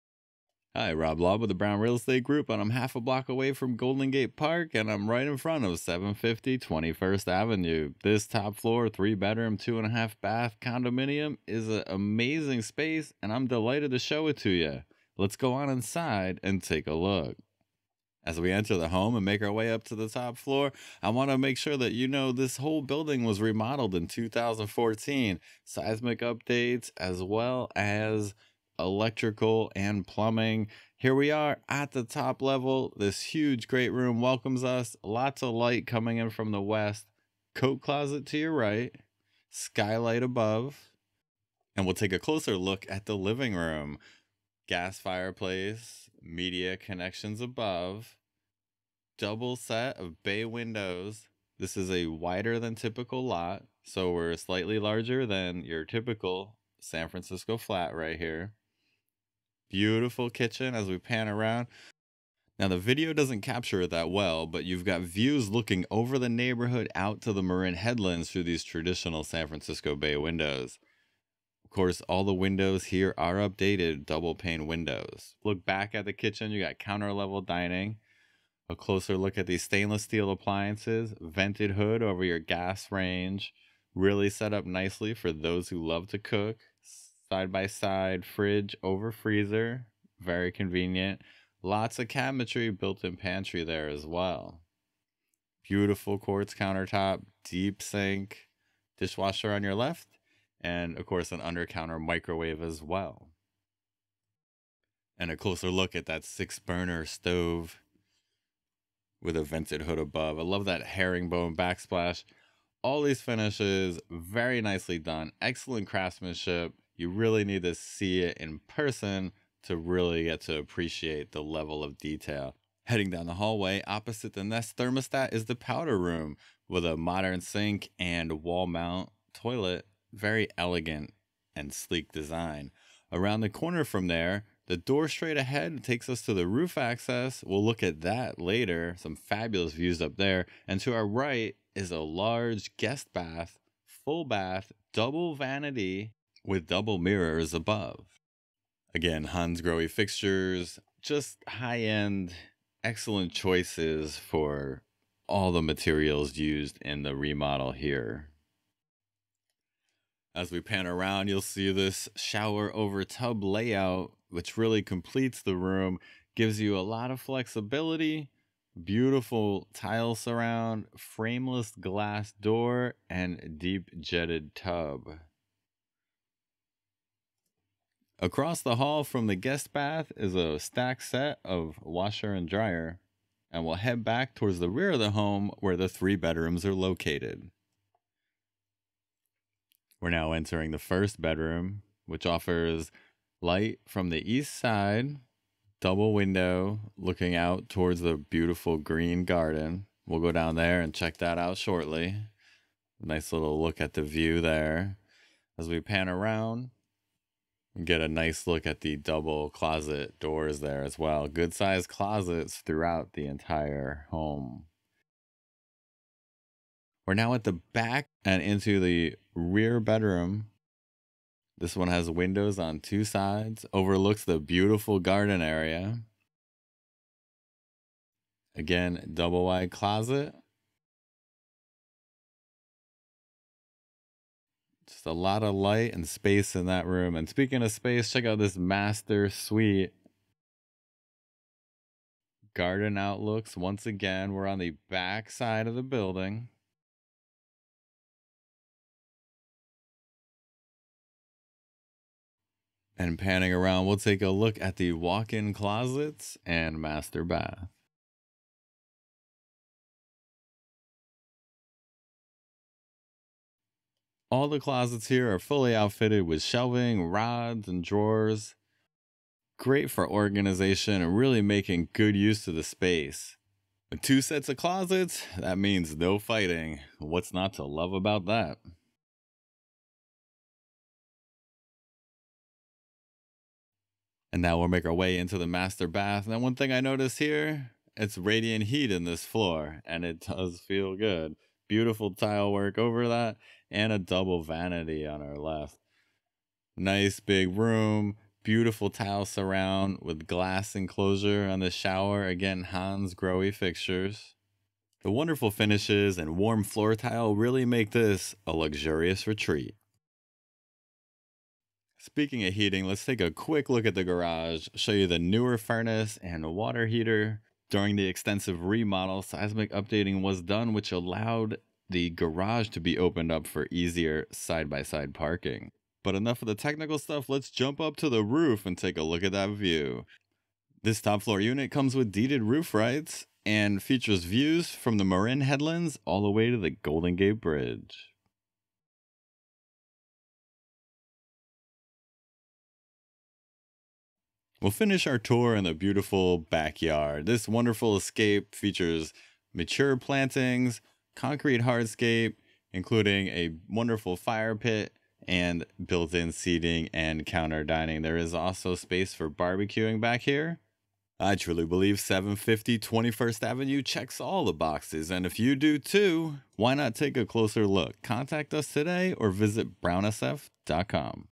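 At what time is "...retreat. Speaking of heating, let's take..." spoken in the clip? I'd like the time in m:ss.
5:09.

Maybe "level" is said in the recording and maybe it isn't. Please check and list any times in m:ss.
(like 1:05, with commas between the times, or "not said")
0:32, 1:17, 2:01.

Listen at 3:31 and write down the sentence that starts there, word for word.
Good sized closets throughout the entire home.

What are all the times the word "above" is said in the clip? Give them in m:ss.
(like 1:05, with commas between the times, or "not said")
0:40, 0:47, 1:49, 2:27.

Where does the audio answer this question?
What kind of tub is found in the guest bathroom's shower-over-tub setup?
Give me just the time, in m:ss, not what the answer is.
2:53.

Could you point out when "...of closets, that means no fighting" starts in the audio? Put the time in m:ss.
4:34.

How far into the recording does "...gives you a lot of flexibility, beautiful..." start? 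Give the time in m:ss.
2:46.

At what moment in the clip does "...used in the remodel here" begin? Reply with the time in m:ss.
2:36.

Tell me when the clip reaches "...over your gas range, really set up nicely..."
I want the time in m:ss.
1:22.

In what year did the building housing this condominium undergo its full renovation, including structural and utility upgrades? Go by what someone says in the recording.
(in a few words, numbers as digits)
2014.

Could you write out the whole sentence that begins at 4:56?
Nice big room, beautiful tile surround with glass enclosure on the shower.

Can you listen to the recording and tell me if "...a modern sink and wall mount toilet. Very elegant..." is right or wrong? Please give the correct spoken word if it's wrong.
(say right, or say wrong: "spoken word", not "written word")
right.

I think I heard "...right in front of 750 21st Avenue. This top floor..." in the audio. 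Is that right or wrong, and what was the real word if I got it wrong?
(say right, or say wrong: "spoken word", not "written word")
right.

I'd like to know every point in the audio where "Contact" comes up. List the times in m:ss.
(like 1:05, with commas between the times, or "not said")
6:08.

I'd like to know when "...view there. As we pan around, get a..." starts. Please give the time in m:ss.
3:24.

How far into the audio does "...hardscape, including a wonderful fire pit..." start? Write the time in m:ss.
5:51.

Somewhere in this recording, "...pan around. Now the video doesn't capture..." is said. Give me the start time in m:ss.
1:00.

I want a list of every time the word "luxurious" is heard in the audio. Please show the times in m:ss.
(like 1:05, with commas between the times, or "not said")
5:08.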